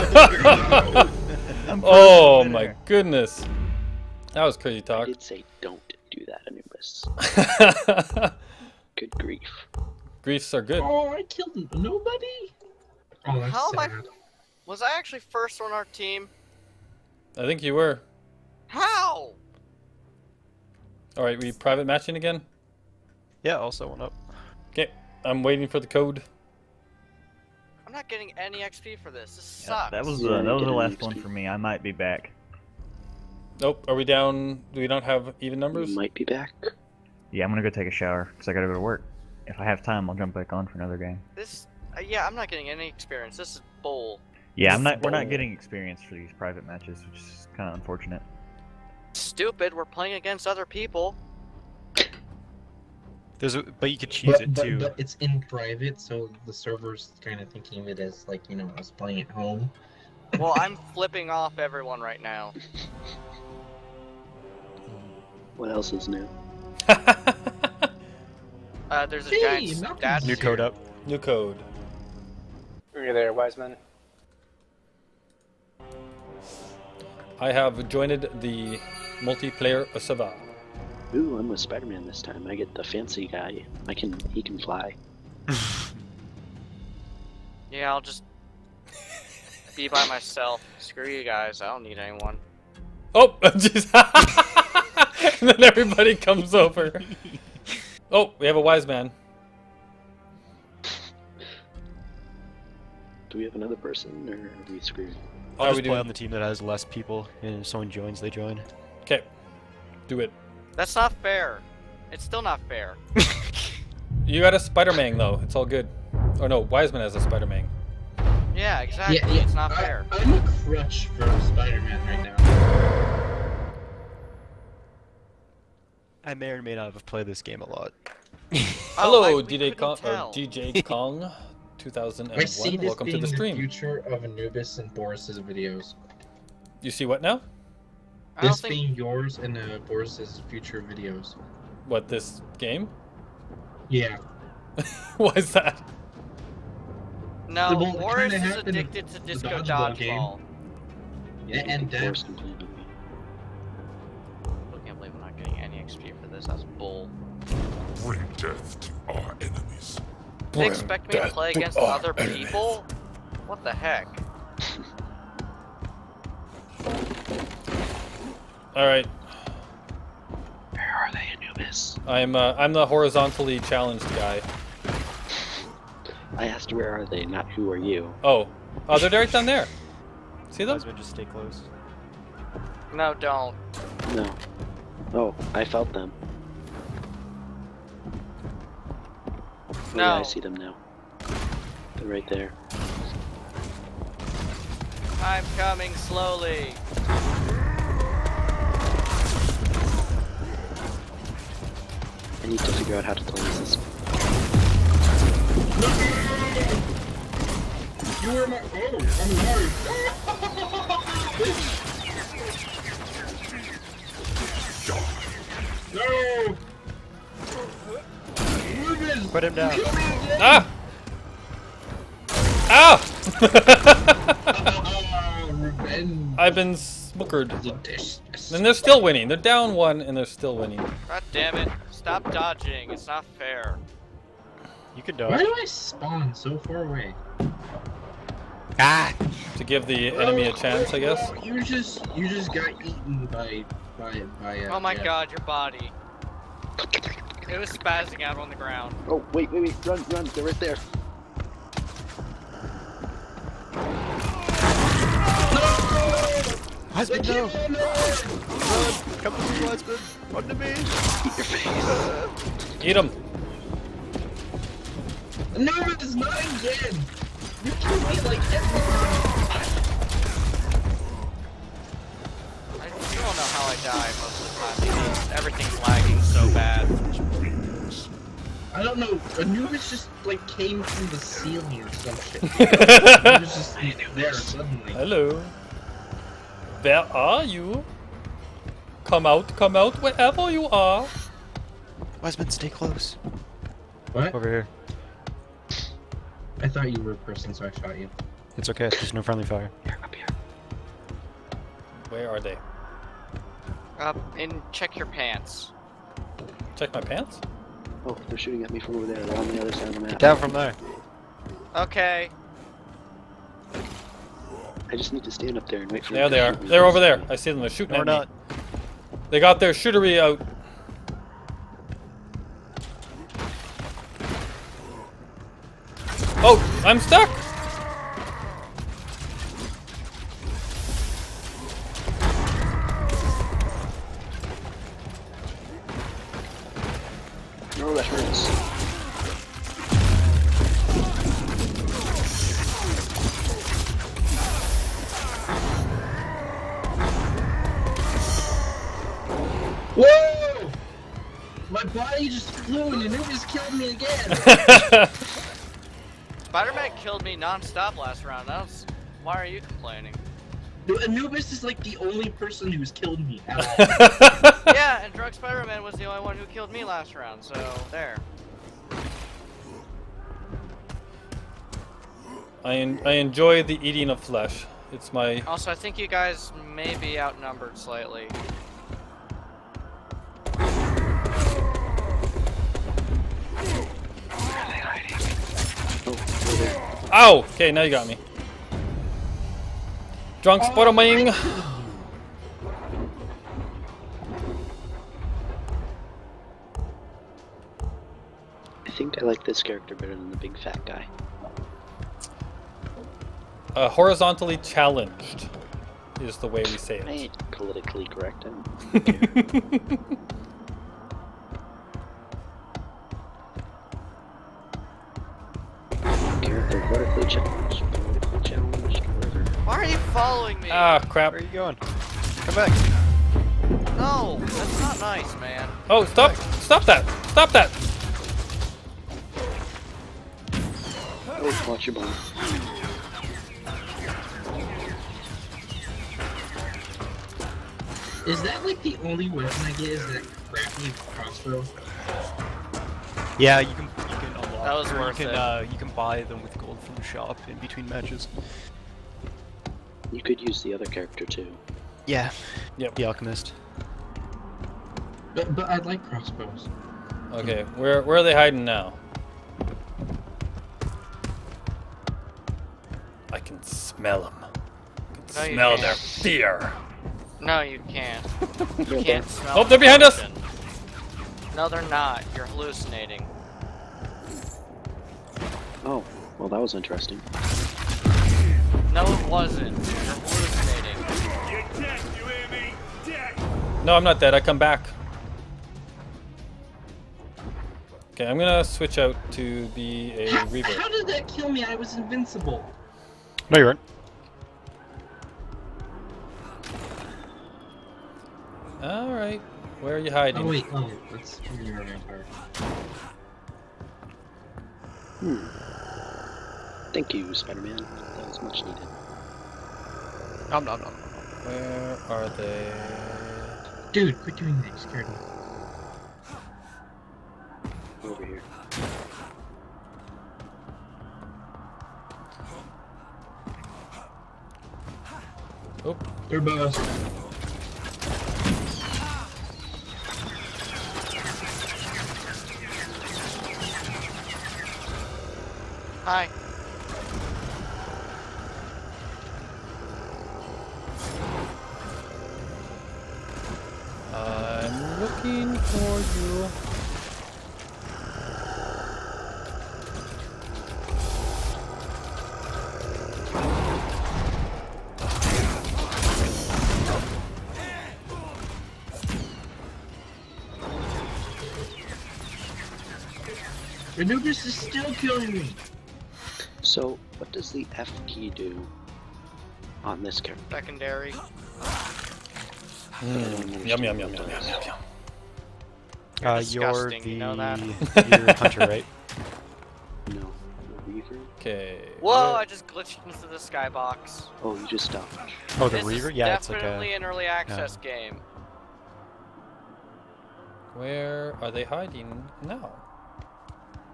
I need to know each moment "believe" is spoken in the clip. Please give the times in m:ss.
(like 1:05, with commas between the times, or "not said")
2:34.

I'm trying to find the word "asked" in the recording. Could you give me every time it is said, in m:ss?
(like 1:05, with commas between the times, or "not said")
2:56.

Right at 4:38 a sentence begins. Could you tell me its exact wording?
I don't know, Anubis just like came from the ceiling or some shit.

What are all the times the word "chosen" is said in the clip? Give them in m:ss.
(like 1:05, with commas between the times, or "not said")
not said.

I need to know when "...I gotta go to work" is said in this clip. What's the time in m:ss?
0:38.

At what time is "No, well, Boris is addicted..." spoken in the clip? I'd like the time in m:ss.
2:27.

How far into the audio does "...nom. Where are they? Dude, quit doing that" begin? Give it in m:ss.
8:30.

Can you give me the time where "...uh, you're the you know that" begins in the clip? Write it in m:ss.
9:36.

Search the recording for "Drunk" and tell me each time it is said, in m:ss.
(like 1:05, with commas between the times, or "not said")
6:30.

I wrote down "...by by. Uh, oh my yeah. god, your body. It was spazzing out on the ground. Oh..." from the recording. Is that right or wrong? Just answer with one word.
right.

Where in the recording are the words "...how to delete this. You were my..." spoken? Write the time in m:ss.
3:23.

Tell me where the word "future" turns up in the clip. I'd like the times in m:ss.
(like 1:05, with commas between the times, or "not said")
2:13, 2:20.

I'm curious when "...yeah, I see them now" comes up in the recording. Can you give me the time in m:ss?
3:09.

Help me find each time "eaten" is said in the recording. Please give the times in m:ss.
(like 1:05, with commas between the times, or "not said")
4:02.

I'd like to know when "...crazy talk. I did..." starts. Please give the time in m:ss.
0:04.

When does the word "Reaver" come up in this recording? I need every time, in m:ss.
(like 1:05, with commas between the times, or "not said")
8:10, 9:45.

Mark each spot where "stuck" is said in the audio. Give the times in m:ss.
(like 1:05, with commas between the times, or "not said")
5:26.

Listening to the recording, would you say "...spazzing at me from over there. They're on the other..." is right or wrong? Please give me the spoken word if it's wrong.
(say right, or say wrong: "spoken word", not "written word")
wrong: "shooting", not "spazzing".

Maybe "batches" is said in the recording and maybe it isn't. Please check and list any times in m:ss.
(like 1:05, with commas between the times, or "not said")
not said.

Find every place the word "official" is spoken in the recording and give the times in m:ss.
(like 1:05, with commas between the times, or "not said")
not said.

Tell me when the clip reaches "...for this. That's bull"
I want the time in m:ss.
2:36.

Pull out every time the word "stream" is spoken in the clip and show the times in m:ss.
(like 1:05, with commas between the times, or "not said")
2:13.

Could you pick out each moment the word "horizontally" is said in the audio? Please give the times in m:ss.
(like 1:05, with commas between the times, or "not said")
2:52, 6:43.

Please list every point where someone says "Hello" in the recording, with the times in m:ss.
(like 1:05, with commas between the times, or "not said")
2:08, 4:44.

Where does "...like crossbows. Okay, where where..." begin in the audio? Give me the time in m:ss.
7:35.